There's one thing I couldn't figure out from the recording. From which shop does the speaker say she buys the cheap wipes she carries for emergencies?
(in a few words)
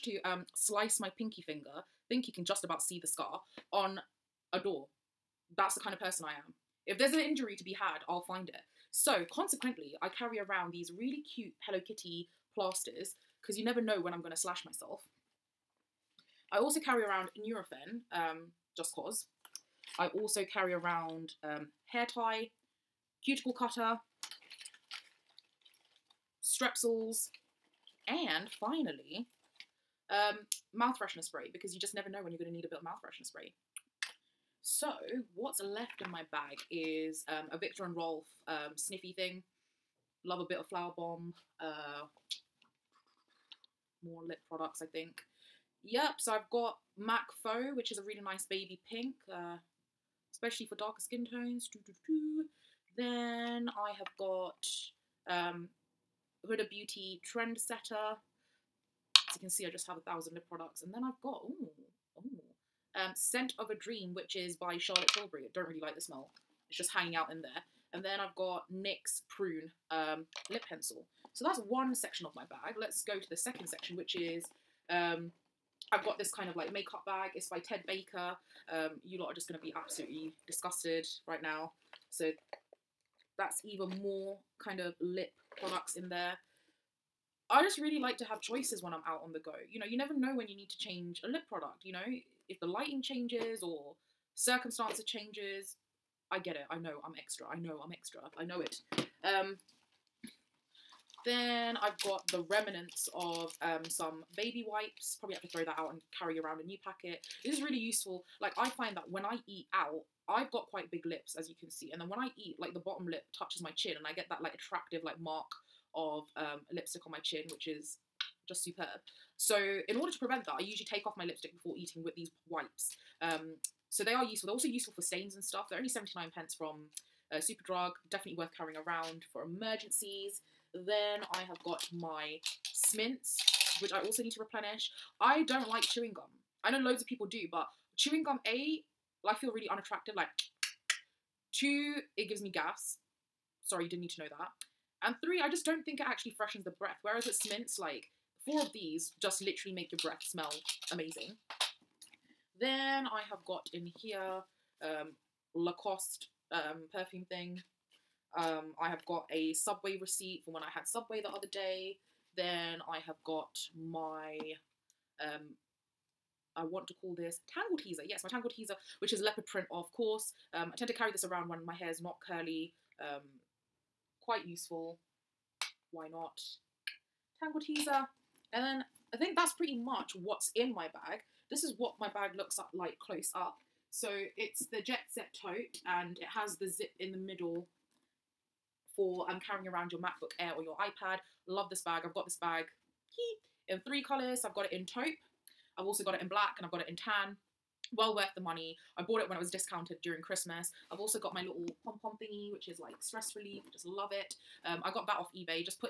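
Superdrug.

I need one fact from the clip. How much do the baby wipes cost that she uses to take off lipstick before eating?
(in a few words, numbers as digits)
79 pence.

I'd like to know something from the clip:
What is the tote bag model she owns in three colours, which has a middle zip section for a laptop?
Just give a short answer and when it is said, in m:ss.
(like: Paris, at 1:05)
Jet Set, at 3:04.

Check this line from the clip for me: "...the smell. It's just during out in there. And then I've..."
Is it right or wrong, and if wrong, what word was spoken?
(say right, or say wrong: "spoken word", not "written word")
wrong: "hanging", not "during".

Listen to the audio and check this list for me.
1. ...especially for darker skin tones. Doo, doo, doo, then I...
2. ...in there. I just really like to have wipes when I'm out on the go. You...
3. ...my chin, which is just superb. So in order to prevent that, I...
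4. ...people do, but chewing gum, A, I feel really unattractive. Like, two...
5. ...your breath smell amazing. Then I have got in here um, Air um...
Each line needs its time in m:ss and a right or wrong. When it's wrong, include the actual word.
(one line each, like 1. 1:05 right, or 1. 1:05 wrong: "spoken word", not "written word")
1. 0:50 right
2. 1:25 wrong: "choices", not "wipes"
3. 1:57 right
4. 2:17 right
5. 2:29 wrong: "Lacoste", not "Air".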